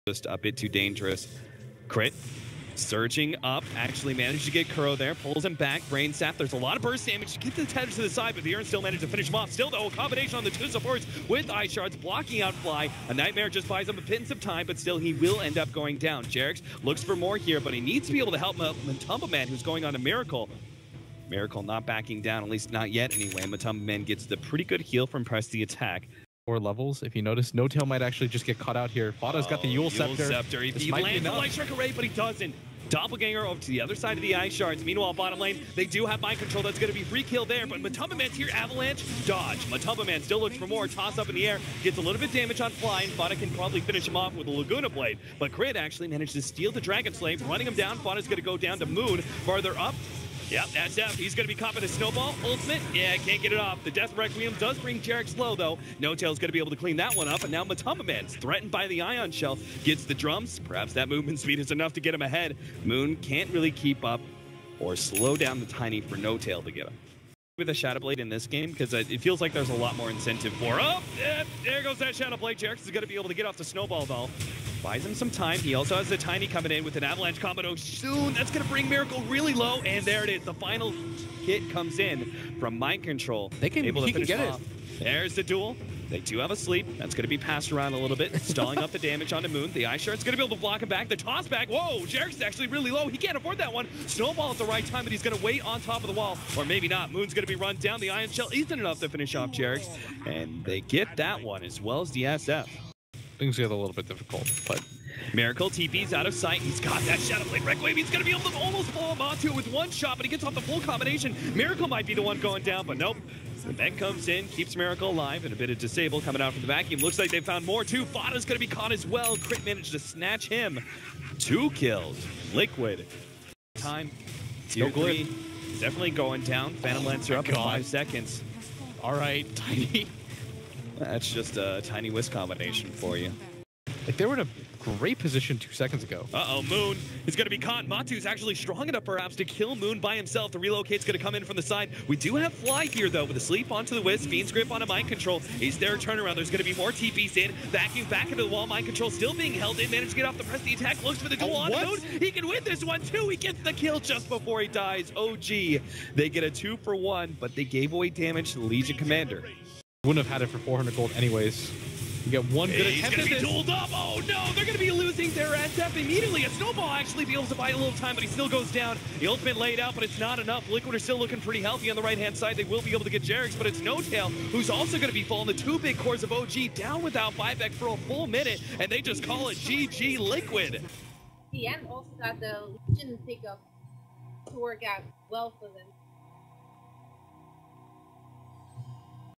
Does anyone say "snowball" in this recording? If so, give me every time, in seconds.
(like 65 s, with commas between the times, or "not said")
51 s, 73 s, 94 s, 166 s.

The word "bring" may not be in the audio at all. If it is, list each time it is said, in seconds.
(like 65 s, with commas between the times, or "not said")
54 s, 78 s.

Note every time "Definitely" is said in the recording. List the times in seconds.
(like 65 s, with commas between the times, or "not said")
125 s.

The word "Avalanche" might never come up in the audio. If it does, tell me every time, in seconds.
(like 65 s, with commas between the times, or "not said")
38 s, 77 s.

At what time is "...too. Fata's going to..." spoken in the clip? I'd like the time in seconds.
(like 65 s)
117 s.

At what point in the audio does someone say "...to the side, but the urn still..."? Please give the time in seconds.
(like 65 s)
7 s.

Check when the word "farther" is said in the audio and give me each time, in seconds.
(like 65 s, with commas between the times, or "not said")
49 s.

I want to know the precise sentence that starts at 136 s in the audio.
Uh-oh, Moon is going to be caught.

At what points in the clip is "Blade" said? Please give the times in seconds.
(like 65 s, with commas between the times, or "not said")
44 s, 67 s, 72 s, 107 s.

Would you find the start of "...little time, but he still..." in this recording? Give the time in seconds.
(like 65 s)
167 s.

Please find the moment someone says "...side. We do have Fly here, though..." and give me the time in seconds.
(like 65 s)
141 s.